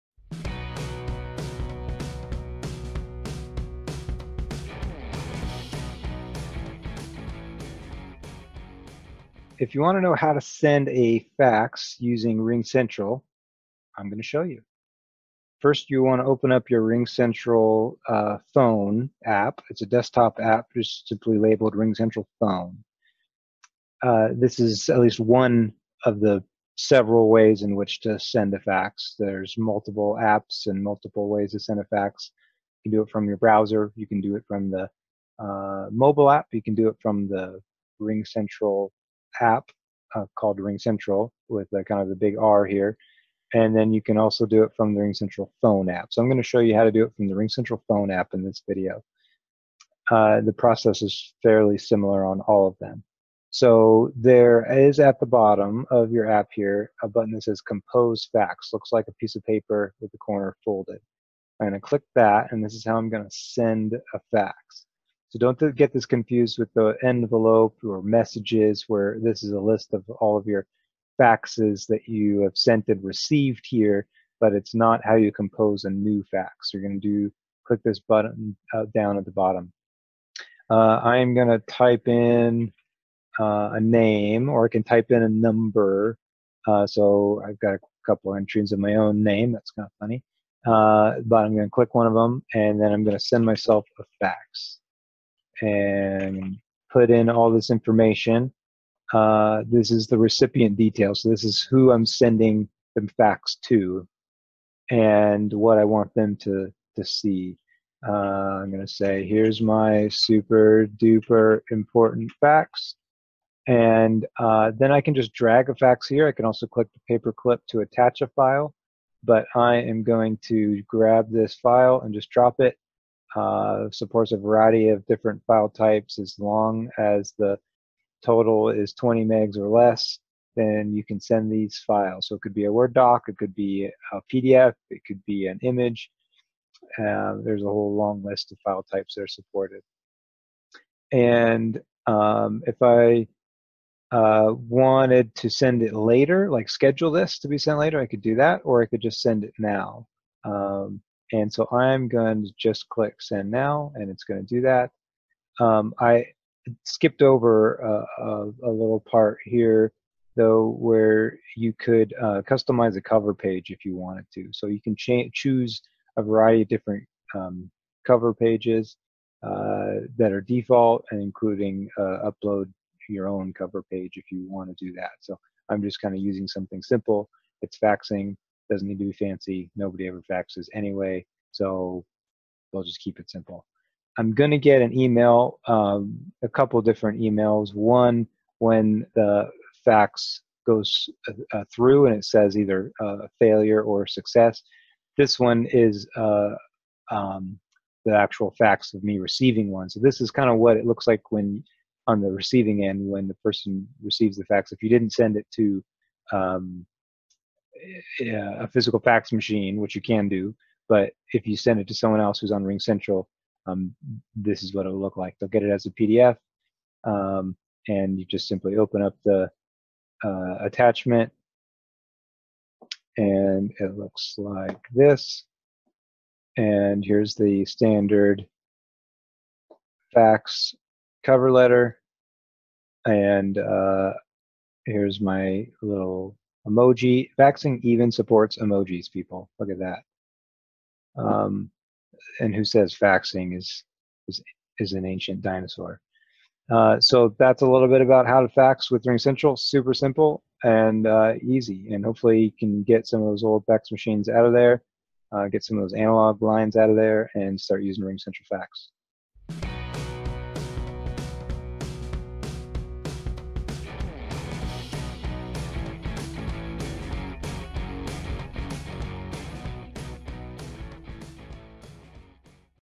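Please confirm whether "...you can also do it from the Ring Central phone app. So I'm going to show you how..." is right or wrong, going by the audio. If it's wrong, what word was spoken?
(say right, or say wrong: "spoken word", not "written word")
right.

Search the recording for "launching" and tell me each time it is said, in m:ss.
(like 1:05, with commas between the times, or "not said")
not said.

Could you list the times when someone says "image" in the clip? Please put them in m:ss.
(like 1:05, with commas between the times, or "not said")
2:15.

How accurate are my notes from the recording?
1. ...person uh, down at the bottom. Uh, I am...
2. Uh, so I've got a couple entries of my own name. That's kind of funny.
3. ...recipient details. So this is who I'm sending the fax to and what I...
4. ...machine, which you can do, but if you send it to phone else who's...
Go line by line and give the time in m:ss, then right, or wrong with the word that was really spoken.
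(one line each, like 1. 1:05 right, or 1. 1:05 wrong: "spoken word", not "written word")
1. 1:18 wrong: "button", not "person"
2. 1:26 right
3. 1:40 right
4. 3:29 wrong: "someone", not "phone".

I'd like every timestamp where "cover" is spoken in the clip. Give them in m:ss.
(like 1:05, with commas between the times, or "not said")
2:43, 2:48, 2:53, 3:51.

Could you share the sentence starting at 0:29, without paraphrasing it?
There's multiple apps and multiple ways to send a fax.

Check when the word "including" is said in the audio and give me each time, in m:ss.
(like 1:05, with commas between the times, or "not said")
2:51.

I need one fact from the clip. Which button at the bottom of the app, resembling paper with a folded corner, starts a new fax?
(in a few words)
Compose Fax.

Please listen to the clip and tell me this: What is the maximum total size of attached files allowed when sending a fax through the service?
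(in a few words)
20 megs.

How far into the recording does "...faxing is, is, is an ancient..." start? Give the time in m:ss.
4:02.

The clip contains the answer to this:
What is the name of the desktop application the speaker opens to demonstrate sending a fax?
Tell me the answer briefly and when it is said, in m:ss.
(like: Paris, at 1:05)
RingCentral phone, at 0:21.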